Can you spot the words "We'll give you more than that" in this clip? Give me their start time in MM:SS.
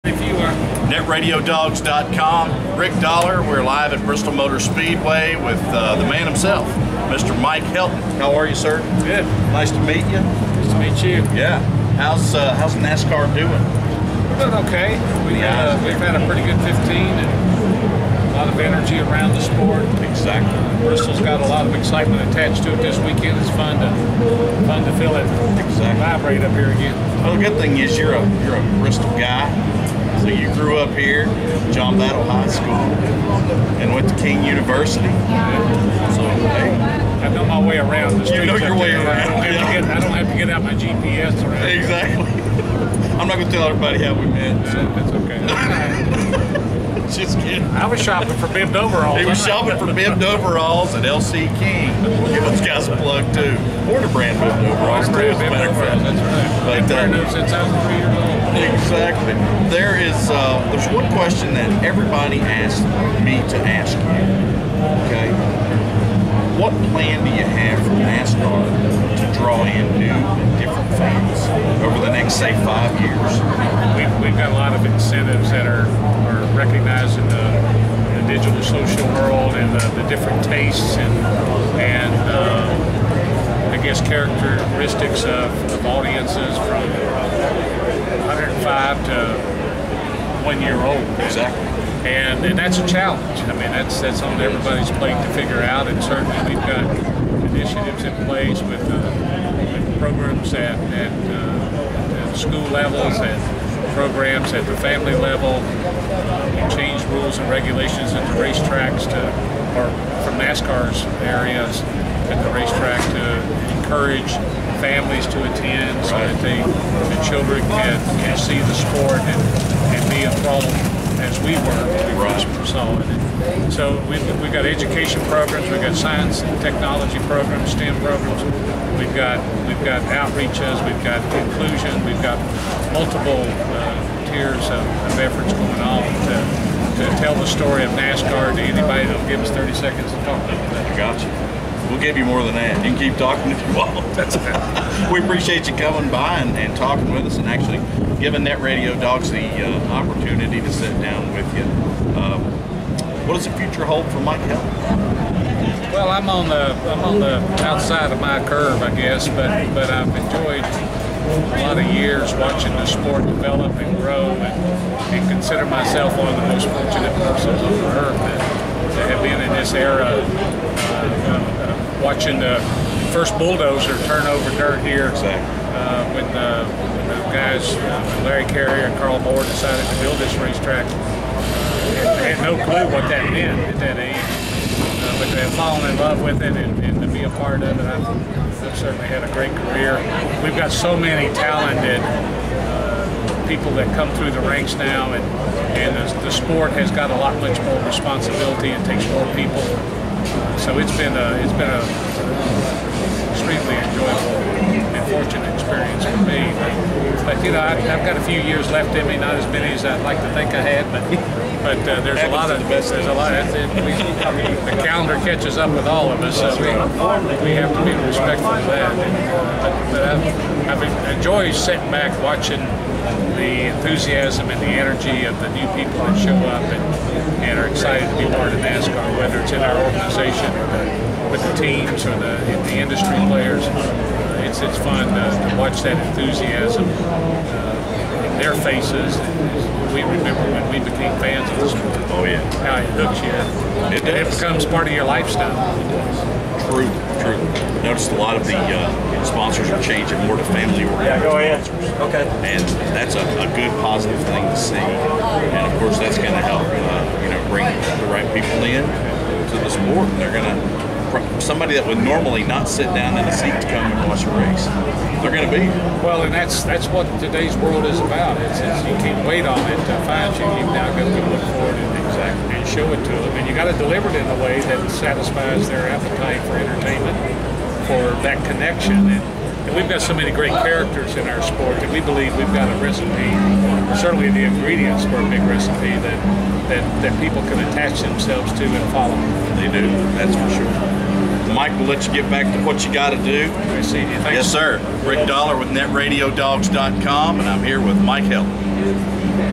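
02:21.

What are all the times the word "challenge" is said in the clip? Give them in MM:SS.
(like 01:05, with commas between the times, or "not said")
01:32.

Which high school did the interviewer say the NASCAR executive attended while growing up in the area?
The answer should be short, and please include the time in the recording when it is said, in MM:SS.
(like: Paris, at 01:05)
John Battle High School, at 00:31.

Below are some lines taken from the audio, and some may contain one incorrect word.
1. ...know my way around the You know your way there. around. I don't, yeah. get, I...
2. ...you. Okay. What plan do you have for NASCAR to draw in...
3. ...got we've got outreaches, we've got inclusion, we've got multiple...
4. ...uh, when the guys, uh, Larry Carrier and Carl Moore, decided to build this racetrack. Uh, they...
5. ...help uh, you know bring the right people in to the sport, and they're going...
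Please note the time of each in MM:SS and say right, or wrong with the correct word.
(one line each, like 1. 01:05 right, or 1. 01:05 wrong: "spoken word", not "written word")
1. 00:37 right
2. 01:03 right
3. 02:09 right
4. 02:56 right
5. 04:16 right.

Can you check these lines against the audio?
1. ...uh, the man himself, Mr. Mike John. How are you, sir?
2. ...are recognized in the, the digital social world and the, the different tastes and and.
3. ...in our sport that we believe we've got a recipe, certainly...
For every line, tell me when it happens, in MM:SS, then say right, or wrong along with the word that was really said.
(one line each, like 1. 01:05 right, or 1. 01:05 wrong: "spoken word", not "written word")
1. 00:05 wrong: "Helton", not "John"
2. 01:15 right
3. 04:41 right.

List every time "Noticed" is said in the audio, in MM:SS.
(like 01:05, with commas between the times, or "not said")
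04:07.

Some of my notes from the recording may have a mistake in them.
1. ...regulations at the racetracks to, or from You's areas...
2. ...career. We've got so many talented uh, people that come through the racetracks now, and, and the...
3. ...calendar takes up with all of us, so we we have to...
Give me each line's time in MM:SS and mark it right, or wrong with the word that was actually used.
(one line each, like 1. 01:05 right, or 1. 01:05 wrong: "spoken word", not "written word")
1. 01:47 wrong: "NASCAR", not "You"
2. 03:09 wrong: "ranks", not "racetracks"
3. 03:34 wrong: "catches", not "takes".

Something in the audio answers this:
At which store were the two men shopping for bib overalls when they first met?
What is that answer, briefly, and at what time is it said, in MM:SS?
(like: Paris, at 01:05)
LC King, at 00:51.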